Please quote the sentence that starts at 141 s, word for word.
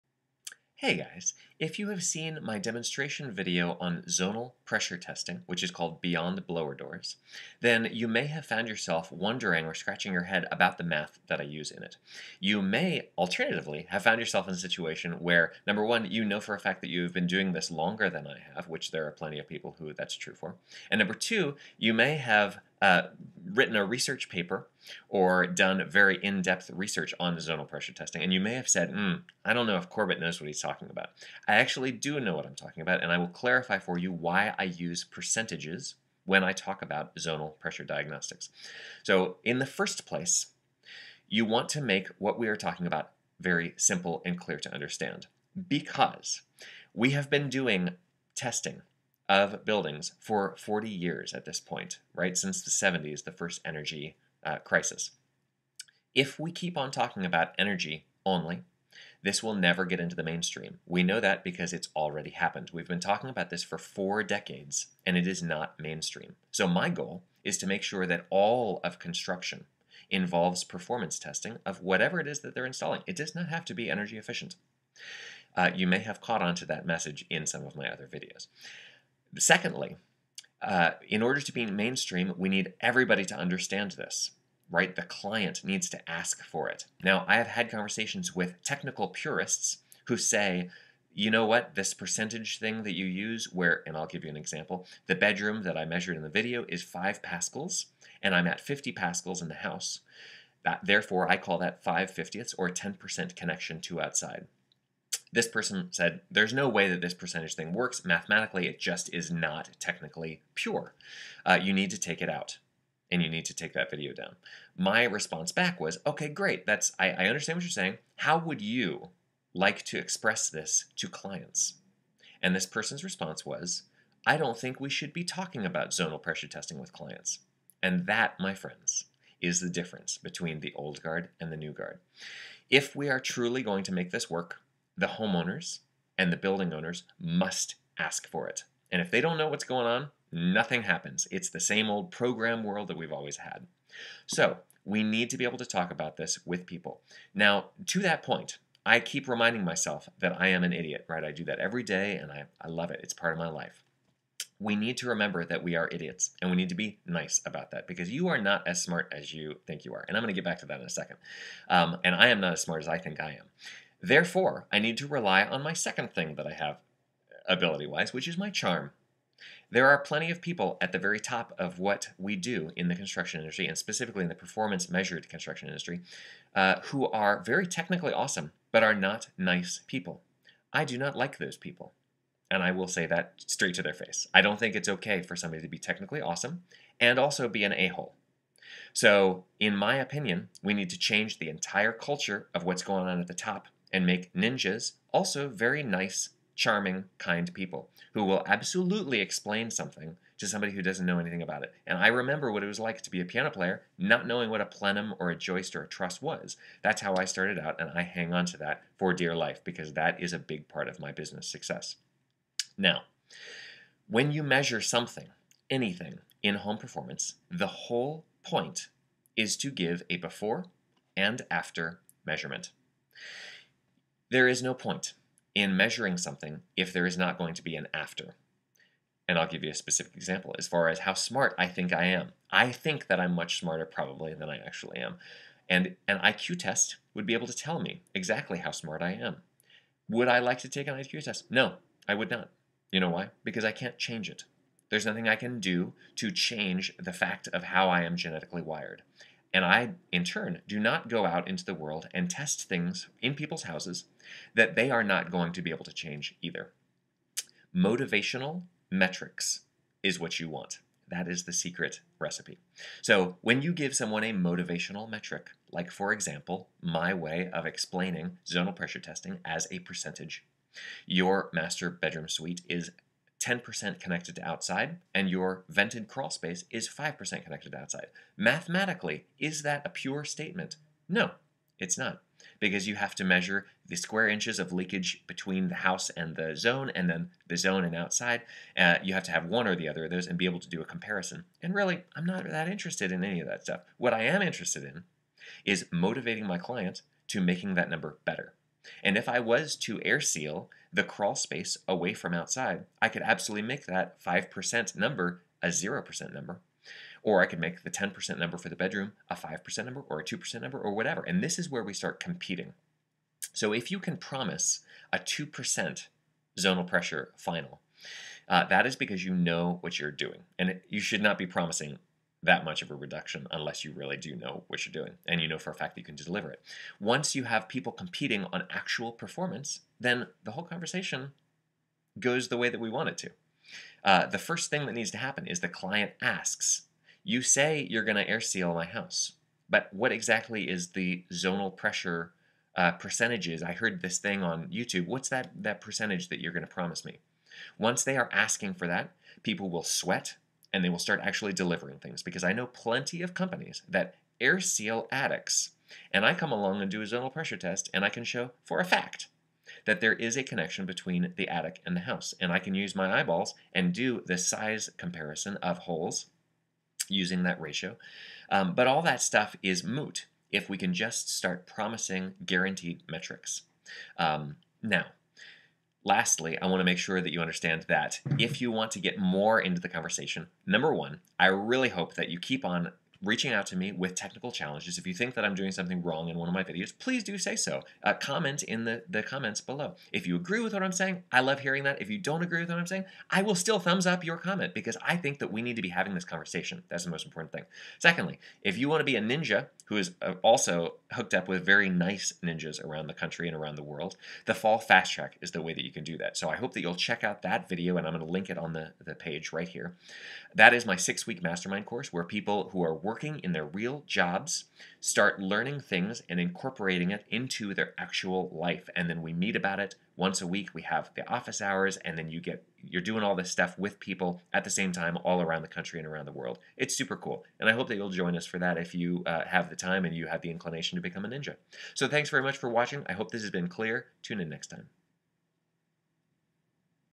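It's the same old program world that we've always had.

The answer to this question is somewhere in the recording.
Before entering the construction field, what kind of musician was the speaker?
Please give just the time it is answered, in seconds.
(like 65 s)
203 s.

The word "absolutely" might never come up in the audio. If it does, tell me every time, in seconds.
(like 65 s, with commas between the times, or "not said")
198 s, 303 s.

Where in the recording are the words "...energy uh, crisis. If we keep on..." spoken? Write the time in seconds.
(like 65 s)
53 s.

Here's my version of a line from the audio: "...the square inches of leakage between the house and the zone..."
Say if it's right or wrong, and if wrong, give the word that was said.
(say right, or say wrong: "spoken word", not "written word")
right.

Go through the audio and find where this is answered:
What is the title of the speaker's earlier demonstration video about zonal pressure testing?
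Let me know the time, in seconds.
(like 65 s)
6 s.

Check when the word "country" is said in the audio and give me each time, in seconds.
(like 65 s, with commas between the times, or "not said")
403 s, 425 s.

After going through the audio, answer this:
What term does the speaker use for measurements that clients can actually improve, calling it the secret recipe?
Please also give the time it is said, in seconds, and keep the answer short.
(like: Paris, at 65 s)
Motivational metrics, at 257 s.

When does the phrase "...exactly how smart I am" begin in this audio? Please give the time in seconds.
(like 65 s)
238 s.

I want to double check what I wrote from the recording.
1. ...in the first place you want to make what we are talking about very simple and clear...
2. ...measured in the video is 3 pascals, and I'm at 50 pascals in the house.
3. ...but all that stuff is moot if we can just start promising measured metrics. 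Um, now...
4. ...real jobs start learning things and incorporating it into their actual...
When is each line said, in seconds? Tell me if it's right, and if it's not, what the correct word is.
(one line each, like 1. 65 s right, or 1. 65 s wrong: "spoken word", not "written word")
1. 39 s right
2. 95 s wrong: "5", not "3"
3. 368 s wrong: "guaranteed", not "measured"
4. 413 s right.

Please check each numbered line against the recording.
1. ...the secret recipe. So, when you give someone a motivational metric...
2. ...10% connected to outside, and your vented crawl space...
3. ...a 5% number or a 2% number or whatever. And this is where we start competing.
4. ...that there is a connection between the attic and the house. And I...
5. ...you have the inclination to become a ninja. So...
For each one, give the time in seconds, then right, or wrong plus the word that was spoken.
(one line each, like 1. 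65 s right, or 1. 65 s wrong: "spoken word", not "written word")
1. 261 s right
2. 273 s right
3. 309 s right
4. 359 s right
5. 430 s right.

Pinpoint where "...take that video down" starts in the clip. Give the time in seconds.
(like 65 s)
113 s.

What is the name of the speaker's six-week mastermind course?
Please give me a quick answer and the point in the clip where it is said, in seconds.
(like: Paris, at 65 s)
Fall Fast Track, at 404 s.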